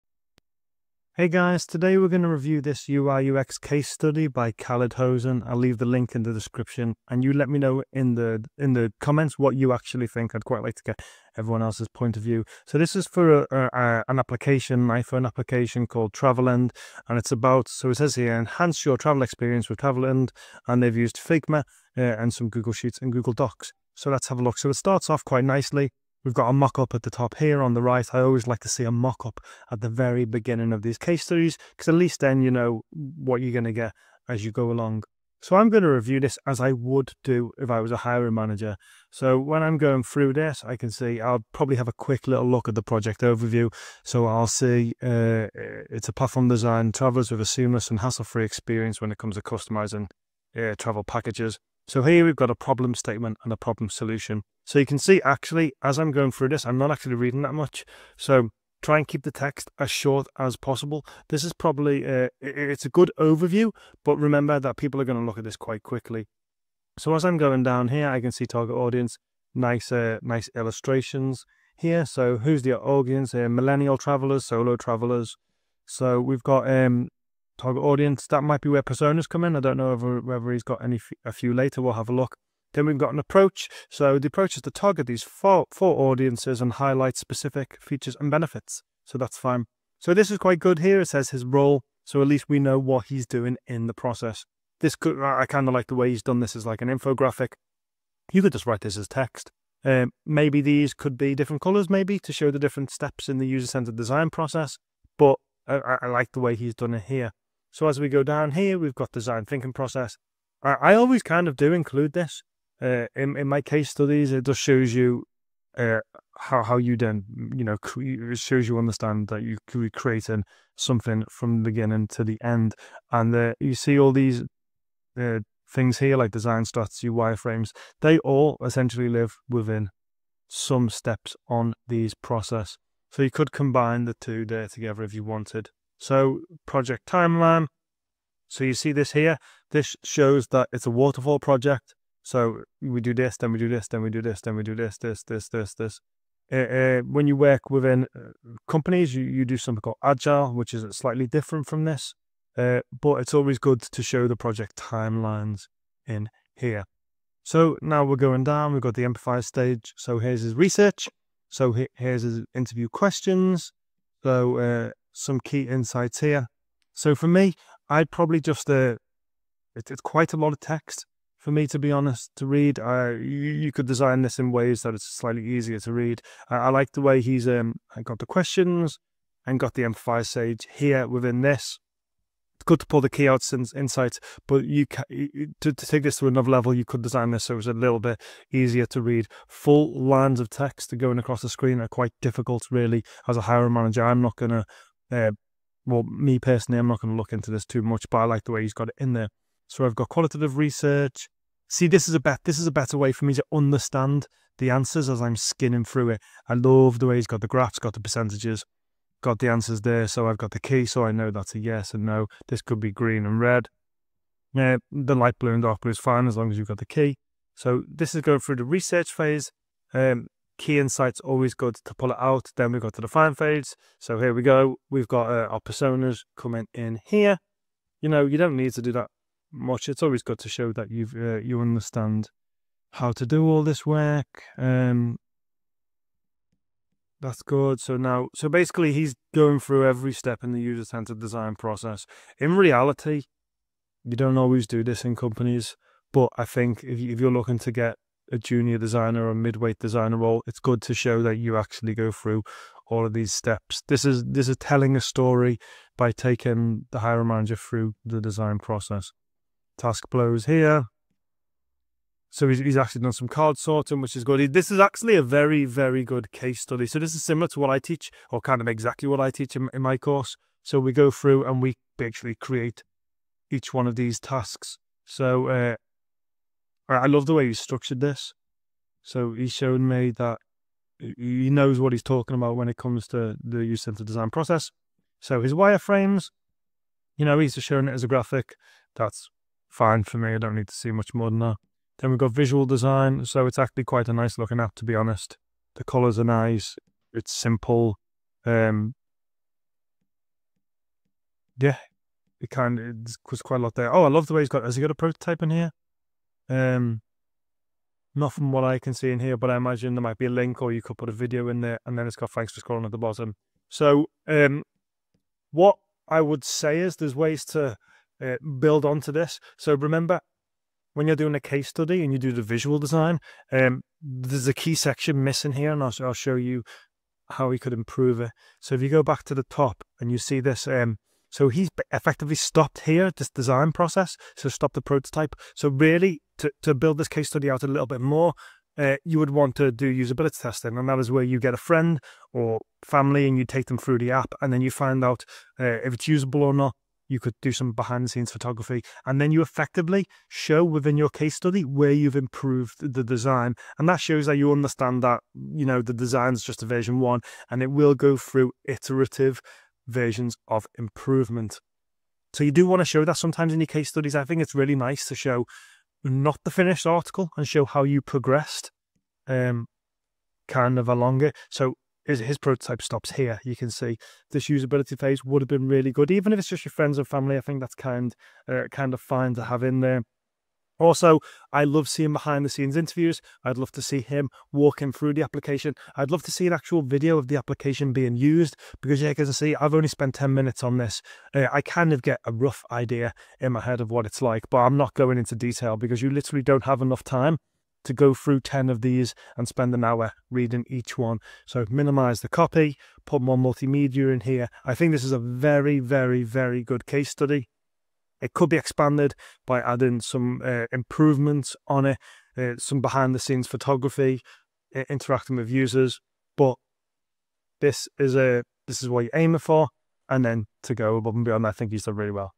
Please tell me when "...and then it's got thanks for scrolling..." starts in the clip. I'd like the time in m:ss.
5:11.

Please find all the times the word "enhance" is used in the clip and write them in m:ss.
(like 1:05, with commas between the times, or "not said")
0:18.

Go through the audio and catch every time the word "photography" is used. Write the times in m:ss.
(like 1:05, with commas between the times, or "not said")
5:48, 6:53.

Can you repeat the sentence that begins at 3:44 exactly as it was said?
We've got uh, our personas coming in here.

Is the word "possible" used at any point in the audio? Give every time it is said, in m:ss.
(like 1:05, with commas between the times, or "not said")
1:00.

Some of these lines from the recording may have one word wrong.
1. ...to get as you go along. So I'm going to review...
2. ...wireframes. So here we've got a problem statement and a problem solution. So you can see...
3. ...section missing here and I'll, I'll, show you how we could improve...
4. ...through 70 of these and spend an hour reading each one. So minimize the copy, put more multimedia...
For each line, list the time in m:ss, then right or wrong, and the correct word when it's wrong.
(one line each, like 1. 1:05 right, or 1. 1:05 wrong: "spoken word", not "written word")
1. 0:33 right
2. 0:51 wrong: "packages", not "wireframes"
3. 5:24 right
4. 6:38 wrong: "10", not "70".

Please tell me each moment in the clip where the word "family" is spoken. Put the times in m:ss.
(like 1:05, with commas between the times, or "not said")
5:42, 6:17.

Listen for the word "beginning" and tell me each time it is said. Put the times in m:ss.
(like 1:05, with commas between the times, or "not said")
0:30, 2:01.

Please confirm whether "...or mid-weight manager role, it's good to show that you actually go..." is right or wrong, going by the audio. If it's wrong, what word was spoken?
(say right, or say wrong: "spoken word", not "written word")
wrong: "designer", not "manager".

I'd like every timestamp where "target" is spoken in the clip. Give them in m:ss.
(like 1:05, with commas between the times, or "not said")
1:08, 1:17, 1:24.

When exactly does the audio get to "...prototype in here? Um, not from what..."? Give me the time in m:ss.
5:04.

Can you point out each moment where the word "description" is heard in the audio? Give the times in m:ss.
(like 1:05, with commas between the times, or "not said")
0:06.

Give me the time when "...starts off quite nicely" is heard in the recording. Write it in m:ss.
0:24.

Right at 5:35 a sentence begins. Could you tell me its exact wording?
So really to, to build this case study out a little bit more, uh, you would want to do usability testing.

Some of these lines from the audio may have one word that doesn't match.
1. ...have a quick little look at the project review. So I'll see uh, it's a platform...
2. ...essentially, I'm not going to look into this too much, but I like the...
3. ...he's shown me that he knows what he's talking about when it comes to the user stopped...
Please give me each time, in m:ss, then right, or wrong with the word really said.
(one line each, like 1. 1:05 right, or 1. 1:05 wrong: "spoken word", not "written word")
1. 0:41 wrong: "overview", not "review"
2. 3:16 wrong: "personally", not "essentially"
3. 4:39 wrong: "centered", not "stopped".